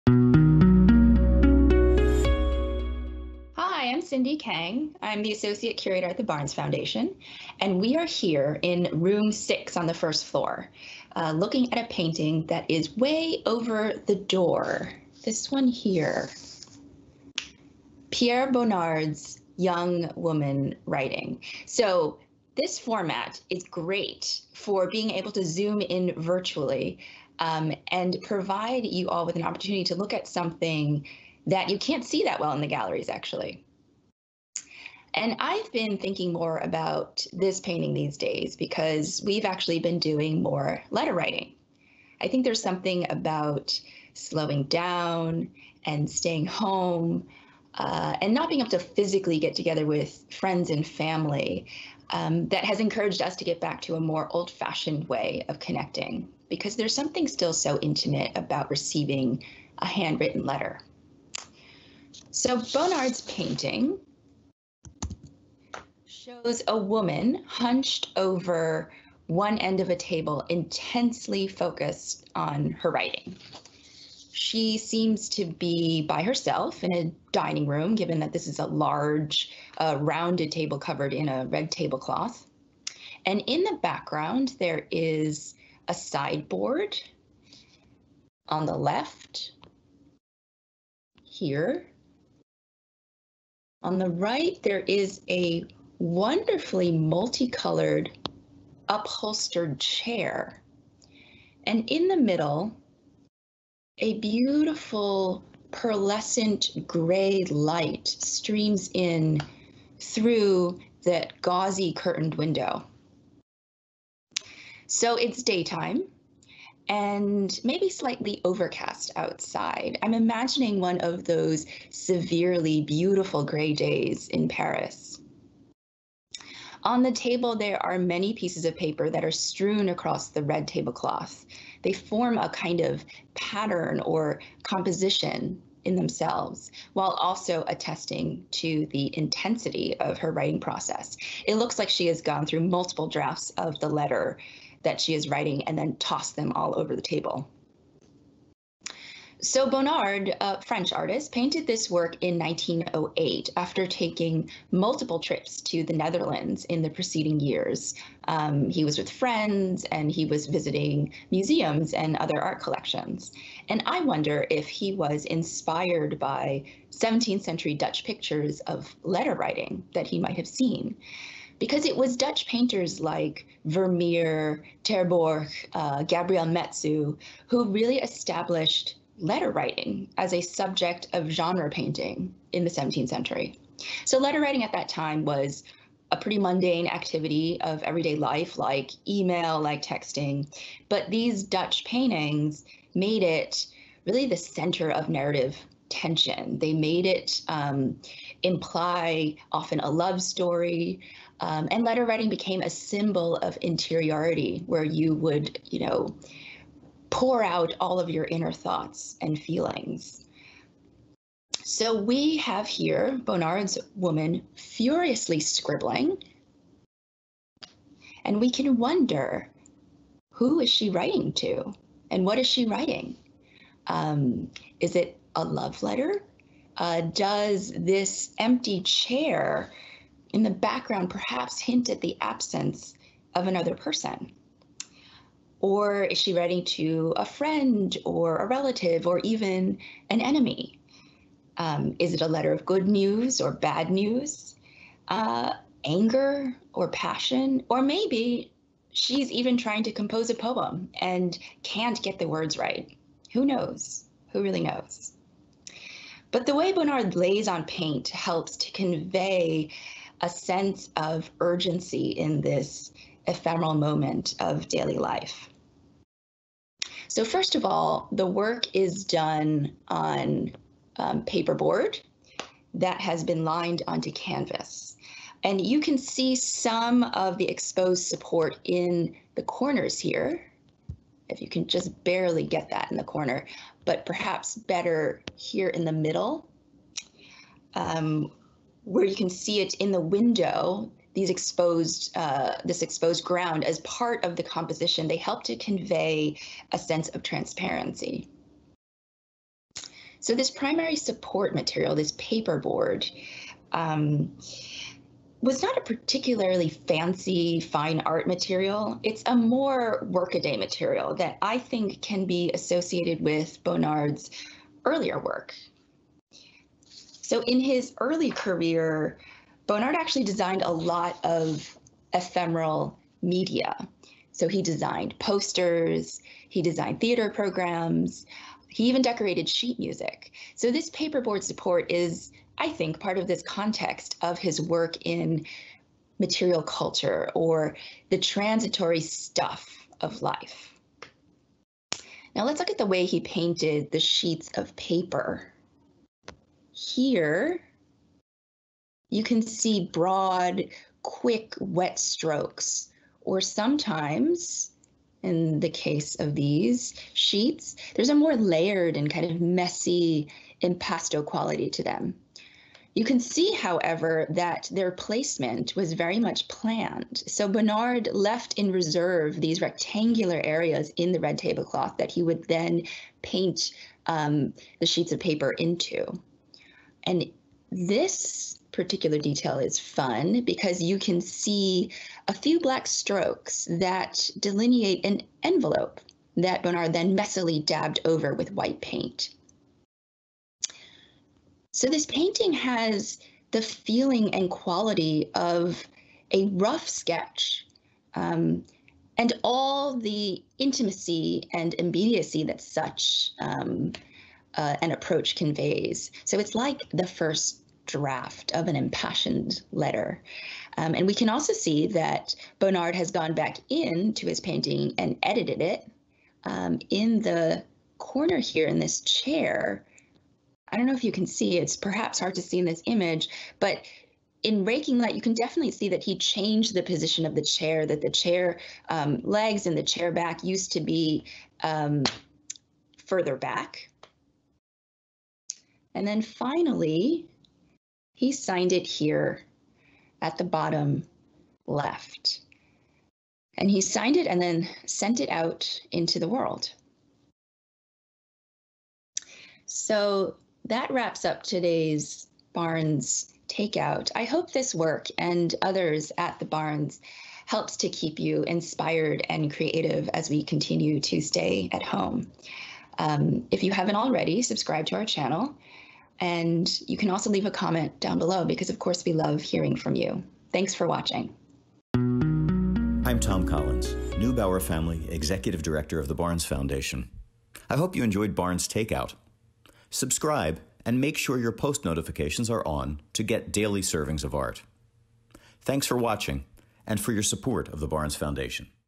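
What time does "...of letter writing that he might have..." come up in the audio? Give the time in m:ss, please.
2:48.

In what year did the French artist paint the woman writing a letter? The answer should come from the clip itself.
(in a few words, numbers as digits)
1908.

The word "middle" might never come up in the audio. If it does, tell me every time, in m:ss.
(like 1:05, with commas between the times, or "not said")
1:42, 4:45.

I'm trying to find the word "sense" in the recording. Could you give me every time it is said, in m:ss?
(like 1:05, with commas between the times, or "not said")
4:20, 4:56.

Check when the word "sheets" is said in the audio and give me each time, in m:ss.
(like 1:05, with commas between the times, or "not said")
5:29, 5:43, 5:57, 6:14.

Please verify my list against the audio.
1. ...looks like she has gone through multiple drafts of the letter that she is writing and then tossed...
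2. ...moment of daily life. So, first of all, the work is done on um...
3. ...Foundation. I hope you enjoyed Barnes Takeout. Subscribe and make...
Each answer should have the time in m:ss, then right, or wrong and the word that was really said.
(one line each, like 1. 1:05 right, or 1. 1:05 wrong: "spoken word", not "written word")
1. 2:21 right
2. 4:23 right
3. 7:56 right.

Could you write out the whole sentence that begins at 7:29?
So that wraps up today's Barnes Takeout.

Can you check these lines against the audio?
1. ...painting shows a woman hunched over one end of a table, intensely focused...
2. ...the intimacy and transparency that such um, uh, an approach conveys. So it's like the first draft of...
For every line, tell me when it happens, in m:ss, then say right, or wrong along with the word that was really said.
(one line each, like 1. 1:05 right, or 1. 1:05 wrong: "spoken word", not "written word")
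1. 1:03 right
2. 6:39 wrong: "immediacy", not "transparency".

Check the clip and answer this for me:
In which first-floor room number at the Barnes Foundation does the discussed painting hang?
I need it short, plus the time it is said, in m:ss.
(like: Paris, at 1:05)
6, at 0:08.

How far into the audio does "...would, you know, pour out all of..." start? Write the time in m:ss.
3:25.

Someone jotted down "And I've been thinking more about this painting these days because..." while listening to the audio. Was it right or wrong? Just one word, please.
right.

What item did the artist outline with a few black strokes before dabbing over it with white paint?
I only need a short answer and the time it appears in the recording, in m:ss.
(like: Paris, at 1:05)
An envelope, at 6:25.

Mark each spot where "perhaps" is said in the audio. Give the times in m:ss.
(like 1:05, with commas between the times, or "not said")
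3:51, 4:44, 7:01.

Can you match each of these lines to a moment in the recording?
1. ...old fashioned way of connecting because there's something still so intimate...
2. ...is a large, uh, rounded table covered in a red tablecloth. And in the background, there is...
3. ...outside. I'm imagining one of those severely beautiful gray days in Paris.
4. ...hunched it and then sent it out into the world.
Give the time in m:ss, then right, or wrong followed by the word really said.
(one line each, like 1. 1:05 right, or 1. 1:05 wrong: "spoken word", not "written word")
1. 0:54 right
2. 1:18 right
3. 1:59 right
4. 7:23 wrong: "signed", not "hunched".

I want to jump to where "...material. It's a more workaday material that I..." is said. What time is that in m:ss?
5:08.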